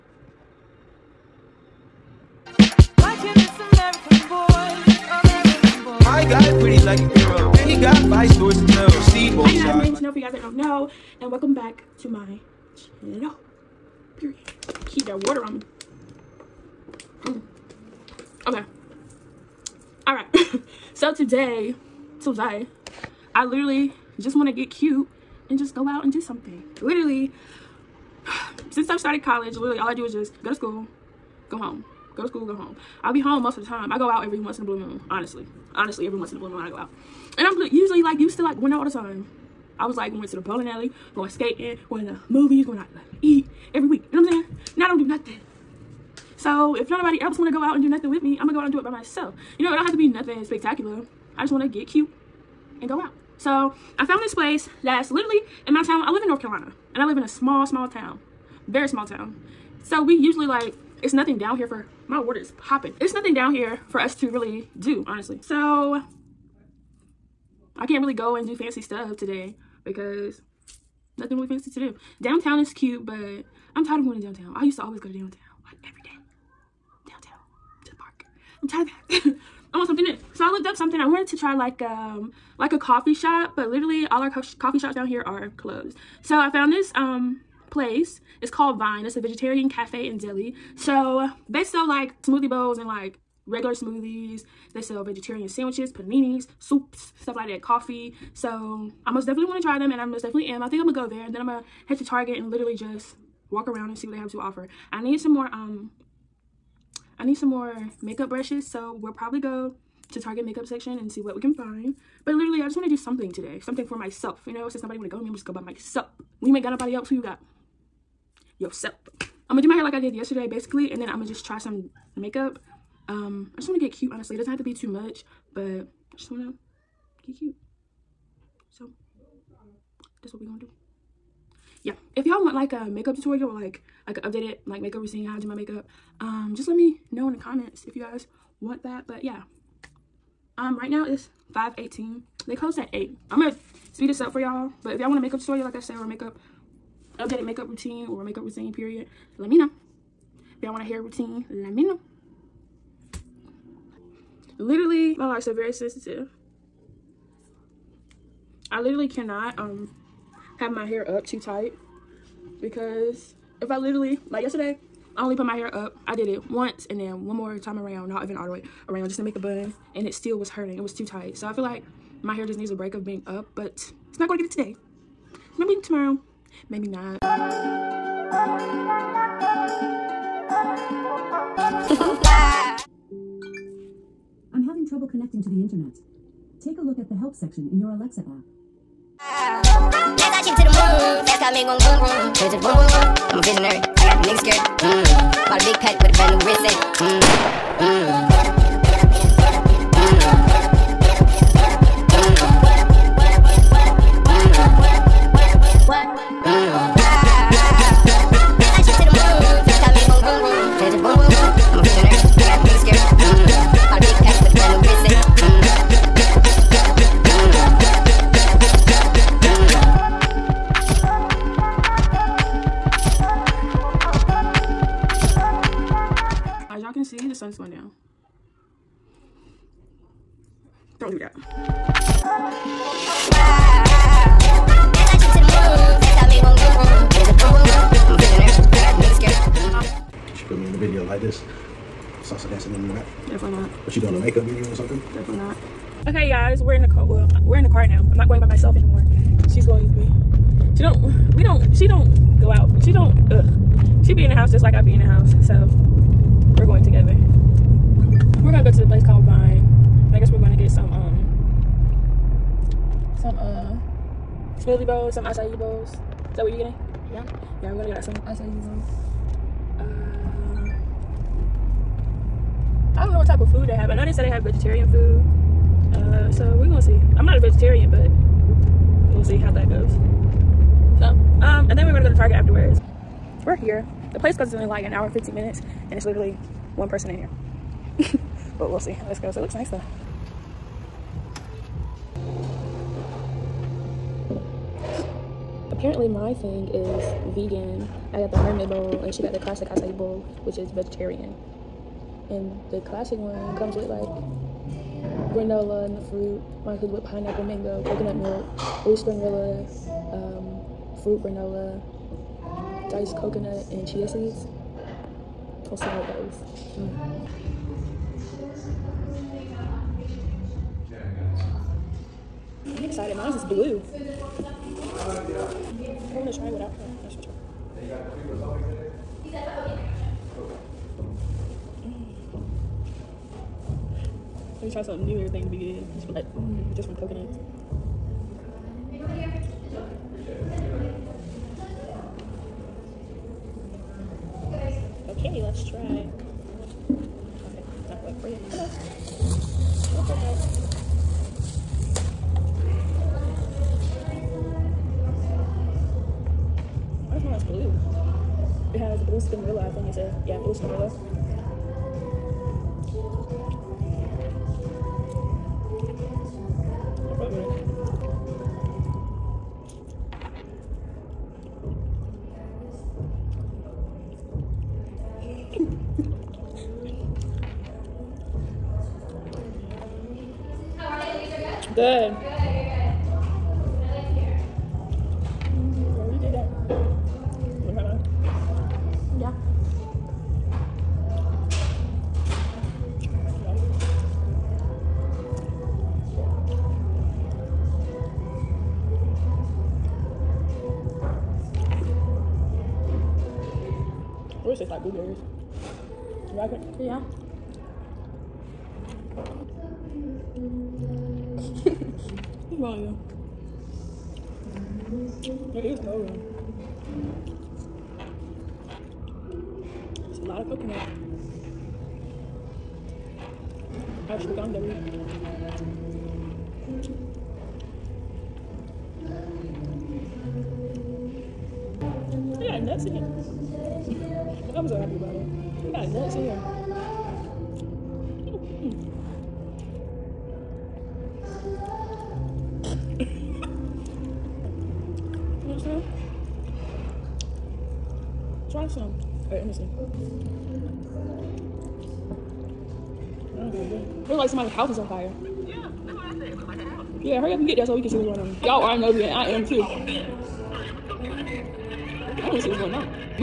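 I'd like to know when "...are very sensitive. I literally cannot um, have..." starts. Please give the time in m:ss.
2:35.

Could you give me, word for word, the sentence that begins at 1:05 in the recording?
So I can't really go and do fancy stuff today because nothing really fancy to do.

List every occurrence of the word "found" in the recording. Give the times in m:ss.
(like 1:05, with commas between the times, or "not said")
0:54, 1:26.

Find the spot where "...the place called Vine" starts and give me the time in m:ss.
4:18.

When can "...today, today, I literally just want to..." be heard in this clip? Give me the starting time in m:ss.
0:21.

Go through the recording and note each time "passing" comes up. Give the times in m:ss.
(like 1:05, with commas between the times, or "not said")
not said.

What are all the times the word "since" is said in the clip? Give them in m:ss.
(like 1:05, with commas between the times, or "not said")
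0:28, 1:54.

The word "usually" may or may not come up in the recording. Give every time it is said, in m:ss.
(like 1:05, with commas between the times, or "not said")
0:37, 1:00.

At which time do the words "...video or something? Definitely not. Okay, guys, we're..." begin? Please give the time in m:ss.
4:04.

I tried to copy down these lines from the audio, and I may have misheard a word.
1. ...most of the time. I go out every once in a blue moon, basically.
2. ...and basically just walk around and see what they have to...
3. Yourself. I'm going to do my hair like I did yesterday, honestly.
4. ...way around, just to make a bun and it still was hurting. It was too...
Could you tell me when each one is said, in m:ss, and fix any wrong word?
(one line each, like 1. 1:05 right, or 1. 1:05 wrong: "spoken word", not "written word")
1. 0:33 wrong: "honestly", not "basically"
2. 1:42 wrong: "literally", not "basically"
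3. 1:58 wrong: "basically", not "honestly"
4. 2:48 right.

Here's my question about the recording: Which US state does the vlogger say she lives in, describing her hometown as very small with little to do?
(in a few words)
North Carolina.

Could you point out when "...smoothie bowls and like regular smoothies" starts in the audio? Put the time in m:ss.
1:32.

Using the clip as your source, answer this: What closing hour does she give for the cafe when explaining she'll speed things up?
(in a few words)
8.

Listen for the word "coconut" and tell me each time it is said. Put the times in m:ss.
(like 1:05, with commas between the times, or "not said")
5:07, 5:13, 5:36.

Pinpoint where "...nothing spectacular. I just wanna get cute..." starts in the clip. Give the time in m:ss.
0:50.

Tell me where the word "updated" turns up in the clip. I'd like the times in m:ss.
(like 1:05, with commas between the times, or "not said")
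2:14, 2:27.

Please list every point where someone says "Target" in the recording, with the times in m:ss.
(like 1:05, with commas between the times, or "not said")
1:42, 1:50, 4:42.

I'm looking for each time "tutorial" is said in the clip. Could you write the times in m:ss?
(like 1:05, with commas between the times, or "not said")
2:13, 2:25.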